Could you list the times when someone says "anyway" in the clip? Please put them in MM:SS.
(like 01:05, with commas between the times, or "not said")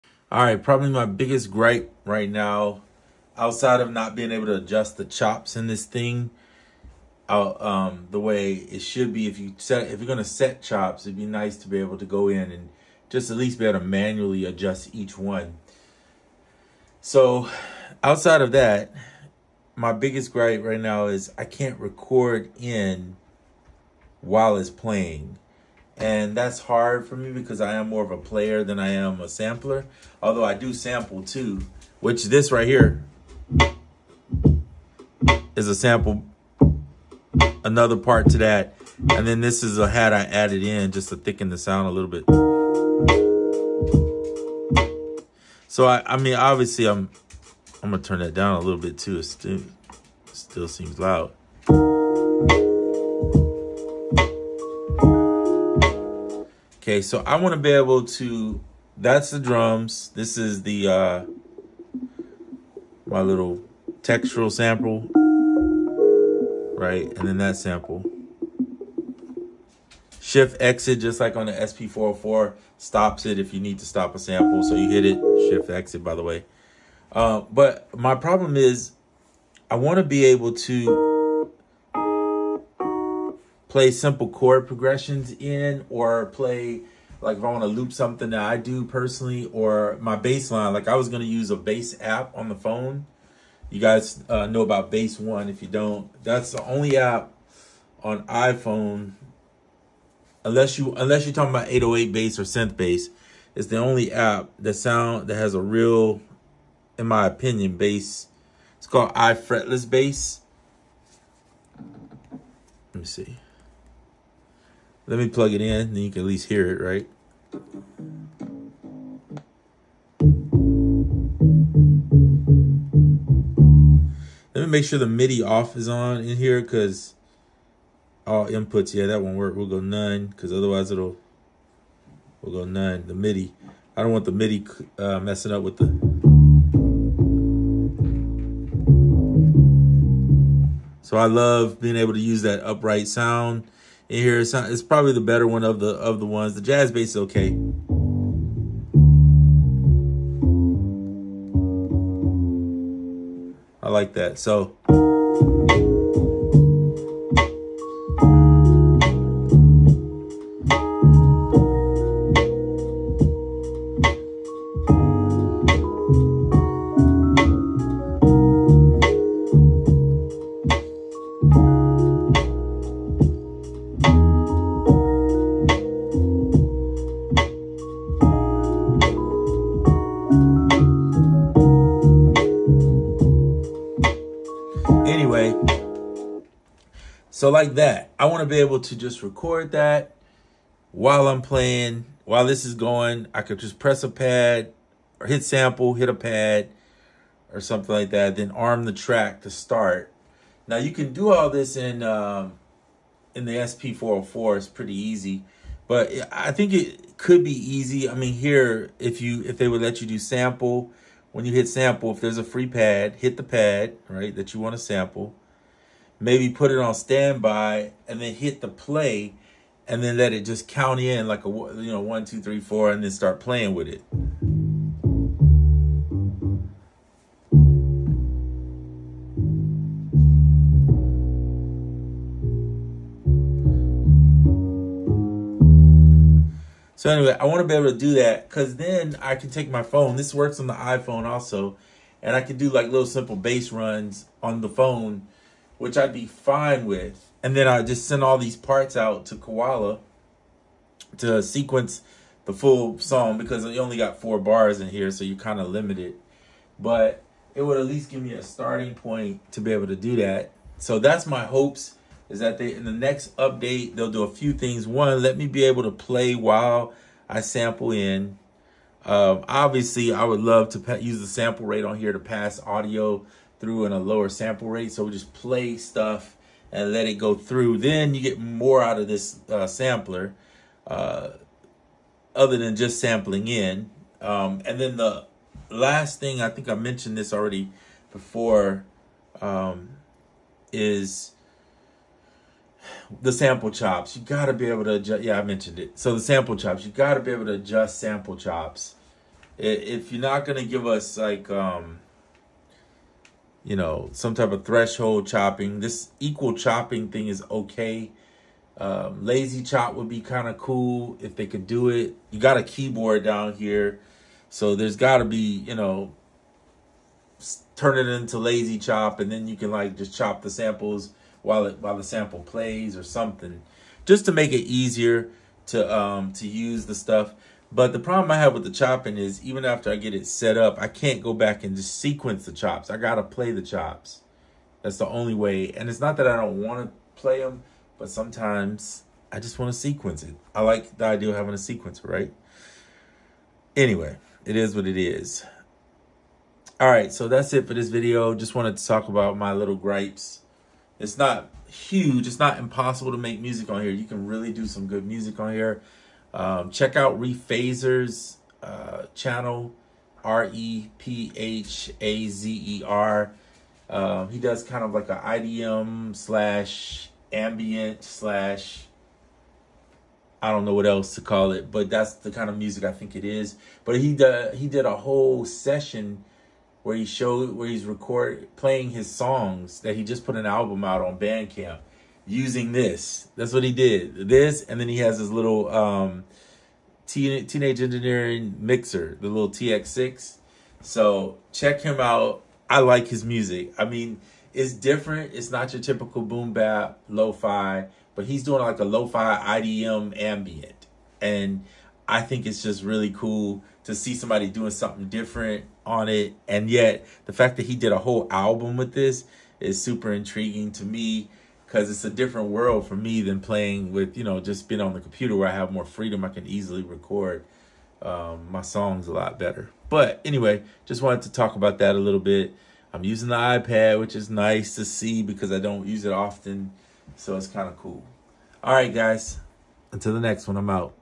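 03:57, 05:43, 07:00.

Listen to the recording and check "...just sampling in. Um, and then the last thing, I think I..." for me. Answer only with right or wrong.
right.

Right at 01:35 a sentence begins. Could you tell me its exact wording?
If you don't, that's the only app on iPhone.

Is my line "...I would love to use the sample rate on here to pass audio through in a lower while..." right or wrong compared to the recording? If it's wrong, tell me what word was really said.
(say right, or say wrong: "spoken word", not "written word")
wrong: "sample", not "while".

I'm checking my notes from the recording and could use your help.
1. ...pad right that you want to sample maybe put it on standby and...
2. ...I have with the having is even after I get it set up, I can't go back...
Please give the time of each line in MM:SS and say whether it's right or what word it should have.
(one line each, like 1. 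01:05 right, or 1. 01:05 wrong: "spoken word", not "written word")
1. 03:33 right
2. 05:28 wrong: "chopping", not "having".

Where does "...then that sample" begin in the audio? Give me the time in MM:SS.
01:07.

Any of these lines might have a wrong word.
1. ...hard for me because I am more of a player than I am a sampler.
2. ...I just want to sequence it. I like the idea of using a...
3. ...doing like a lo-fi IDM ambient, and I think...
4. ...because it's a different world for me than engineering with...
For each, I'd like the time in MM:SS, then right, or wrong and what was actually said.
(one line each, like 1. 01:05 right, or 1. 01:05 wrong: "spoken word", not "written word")
1. 00:26 right
2. 05:39 wrong: "having", not "using"
3. 06:38 right
4. 06:51 wrong: "playing", not "engineering".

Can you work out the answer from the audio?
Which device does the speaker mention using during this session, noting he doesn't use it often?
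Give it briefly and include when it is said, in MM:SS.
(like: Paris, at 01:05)
iPad, at 07:03.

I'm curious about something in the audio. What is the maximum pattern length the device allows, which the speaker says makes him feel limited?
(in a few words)
4 bars.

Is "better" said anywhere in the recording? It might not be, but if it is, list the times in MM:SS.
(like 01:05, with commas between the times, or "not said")
02:25, 06:59.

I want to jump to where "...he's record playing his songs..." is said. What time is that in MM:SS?
06:17.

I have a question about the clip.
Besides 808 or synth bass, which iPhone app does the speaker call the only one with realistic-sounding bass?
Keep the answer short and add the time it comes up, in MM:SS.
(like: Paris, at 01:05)
iFretless Bass, at 01:49.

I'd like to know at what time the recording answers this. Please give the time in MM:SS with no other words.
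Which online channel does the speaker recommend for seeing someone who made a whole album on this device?
05:57.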